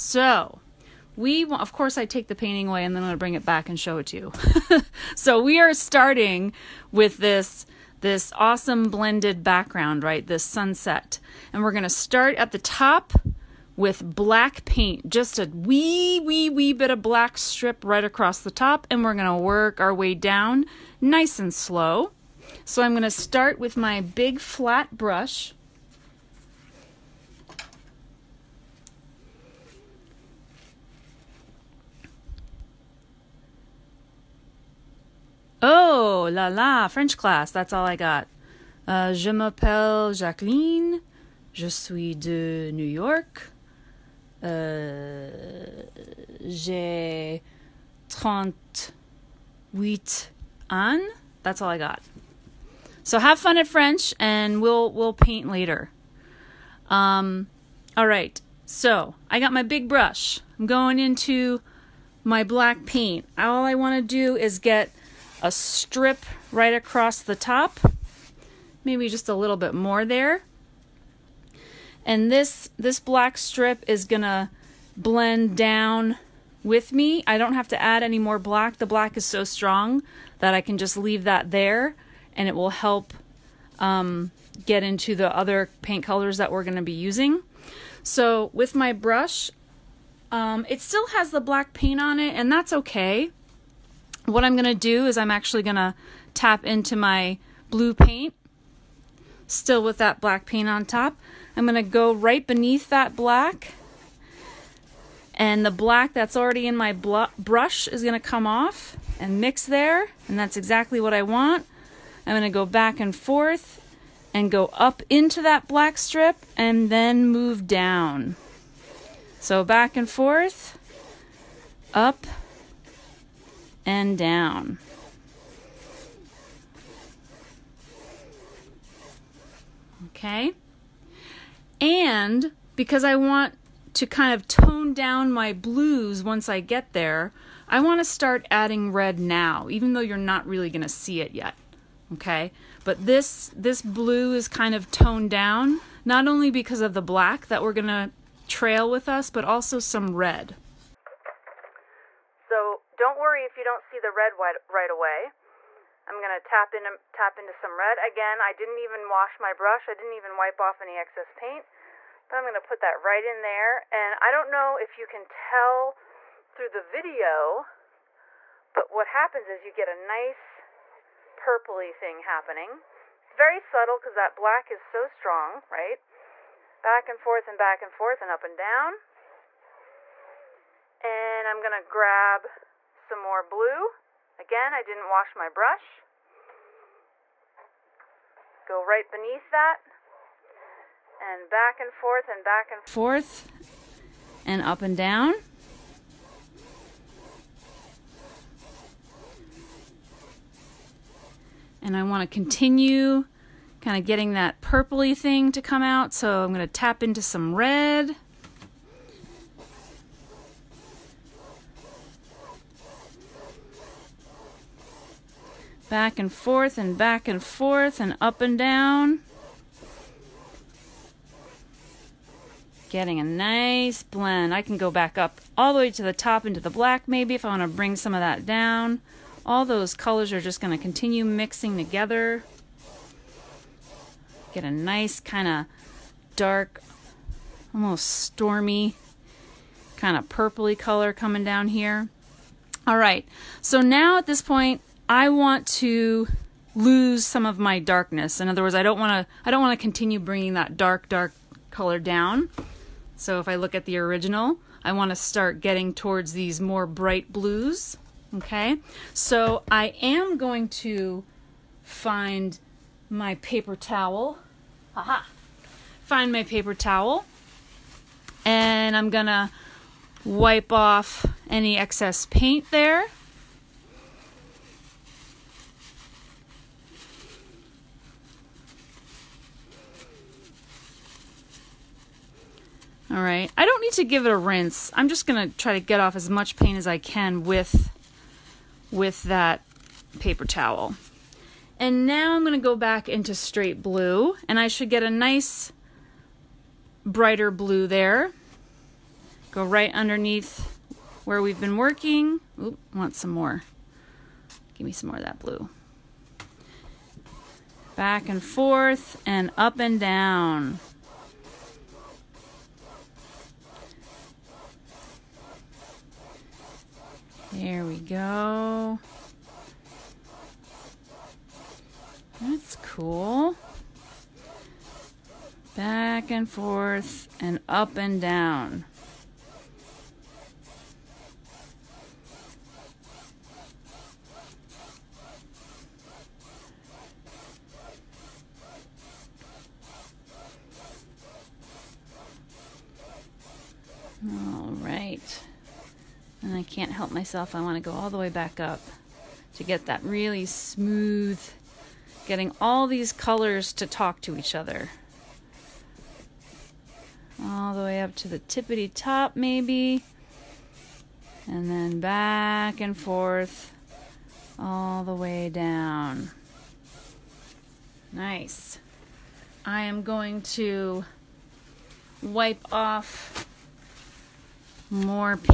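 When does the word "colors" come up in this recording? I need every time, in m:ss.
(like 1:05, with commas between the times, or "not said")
1:26, 3:49, 4:00, 4:11, 5:53.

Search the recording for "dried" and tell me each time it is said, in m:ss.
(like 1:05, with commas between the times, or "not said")
not said.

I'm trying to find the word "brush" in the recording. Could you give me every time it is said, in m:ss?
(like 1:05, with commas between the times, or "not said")
0:24, 0:59, 1:28, 1:46, 2:39, 3:05.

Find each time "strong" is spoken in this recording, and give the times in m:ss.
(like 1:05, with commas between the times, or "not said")
1:19, 2:55.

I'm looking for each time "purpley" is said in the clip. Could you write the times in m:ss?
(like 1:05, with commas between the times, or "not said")
2:51, 3:24, 4:00.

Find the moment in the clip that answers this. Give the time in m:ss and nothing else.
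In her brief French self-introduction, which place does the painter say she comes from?
0:42.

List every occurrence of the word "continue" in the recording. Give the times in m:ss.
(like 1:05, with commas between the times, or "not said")
3:22, 3:50, 4:09.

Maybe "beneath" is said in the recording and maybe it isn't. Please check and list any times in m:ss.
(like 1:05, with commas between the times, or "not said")
1:42, 3:09.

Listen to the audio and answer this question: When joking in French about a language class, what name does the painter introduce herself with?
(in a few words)
Jacqueline.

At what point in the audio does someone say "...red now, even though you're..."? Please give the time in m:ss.
2:18.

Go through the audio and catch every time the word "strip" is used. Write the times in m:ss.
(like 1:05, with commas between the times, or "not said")
0:17, 1:05, 1:13, 1:55.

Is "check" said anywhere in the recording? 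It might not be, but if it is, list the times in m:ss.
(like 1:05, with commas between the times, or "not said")
not said.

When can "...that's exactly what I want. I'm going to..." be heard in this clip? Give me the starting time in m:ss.
1:50.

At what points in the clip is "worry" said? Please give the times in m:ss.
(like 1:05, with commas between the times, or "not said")
2:33.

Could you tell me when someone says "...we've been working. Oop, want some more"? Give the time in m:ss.
5:01.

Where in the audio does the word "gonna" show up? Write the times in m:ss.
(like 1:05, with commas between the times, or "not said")
1:14, 1:26, 2:36, 2:42, 3:01, 3:26, 4:45, 4:52.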